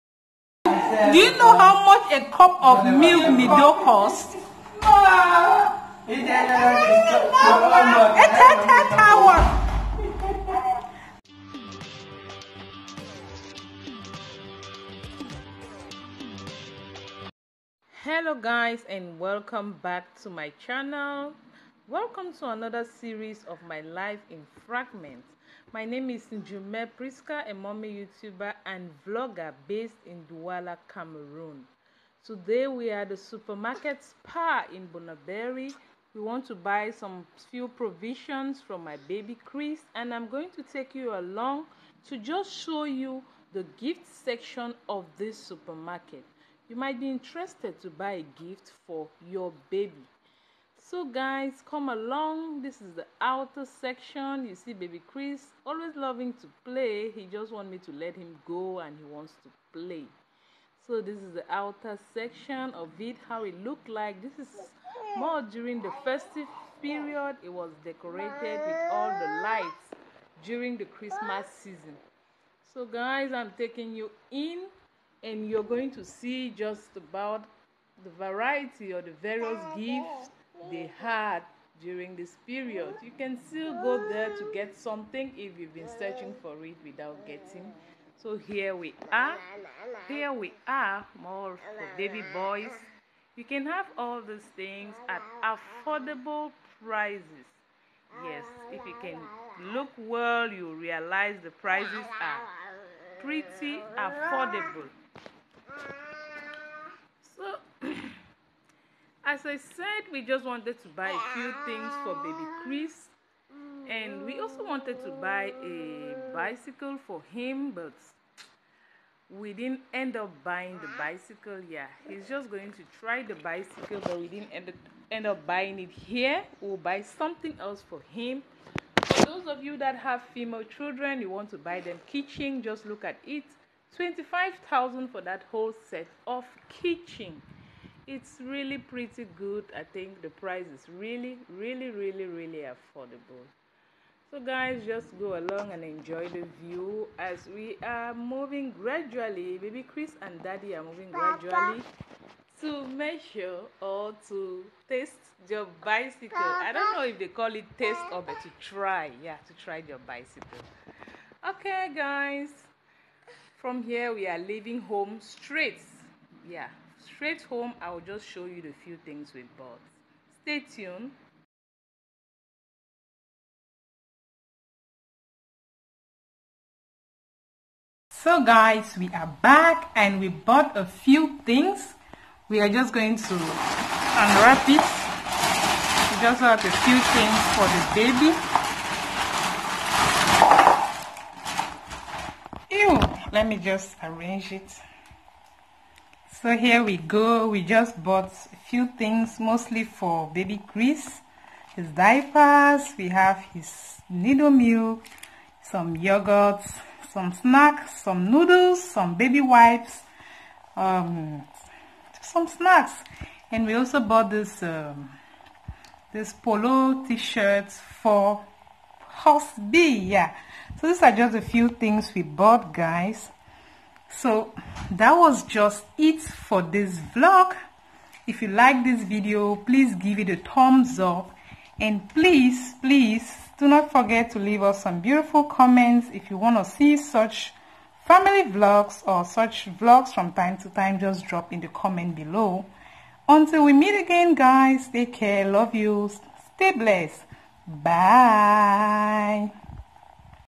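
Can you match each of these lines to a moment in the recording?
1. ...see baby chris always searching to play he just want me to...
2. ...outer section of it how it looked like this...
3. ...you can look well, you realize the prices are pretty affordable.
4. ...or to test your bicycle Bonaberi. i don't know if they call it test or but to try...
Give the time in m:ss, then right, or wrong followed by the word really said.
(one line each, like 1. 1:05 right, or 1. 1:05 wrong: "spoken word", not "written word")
1. 0:54 wrong: "loving", not "searching"
2. 1:01 right
3. 1:38 right
4. 2:33 wrong: "Papa", not "Bonaberi".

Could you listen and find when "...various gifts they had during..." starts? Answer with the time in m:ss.
1:19.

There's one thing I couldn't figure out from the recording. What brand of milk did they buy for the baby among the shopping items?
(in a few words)
Nido.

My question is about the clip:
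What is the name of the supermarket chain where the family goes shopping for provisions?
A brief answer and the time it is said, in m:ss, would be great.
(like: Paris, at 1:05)
Spar, at 0:34.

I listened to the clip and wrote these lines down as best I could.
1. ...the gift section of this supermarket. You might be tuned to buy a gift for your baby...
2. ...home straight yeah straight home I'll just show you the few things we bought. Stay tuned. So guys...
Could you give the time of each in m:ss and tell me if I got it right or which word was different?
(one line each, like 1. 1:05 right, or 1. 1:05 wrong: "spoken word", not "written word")
1. 0:43 wrong: "interested", not "tuned"
2. 2:44 right.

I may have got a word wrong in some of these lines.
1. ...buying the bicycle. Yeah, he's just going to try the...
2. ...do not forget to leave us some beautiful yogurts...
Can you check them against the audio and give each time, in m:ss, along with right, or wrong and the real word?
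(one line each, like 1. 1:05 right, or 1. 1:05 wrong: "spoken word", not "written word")
1. 2:00 right
2. 3:53 wrong: "comments", not "yogurts".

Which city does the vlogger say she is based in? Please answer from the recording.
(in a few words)
Douala.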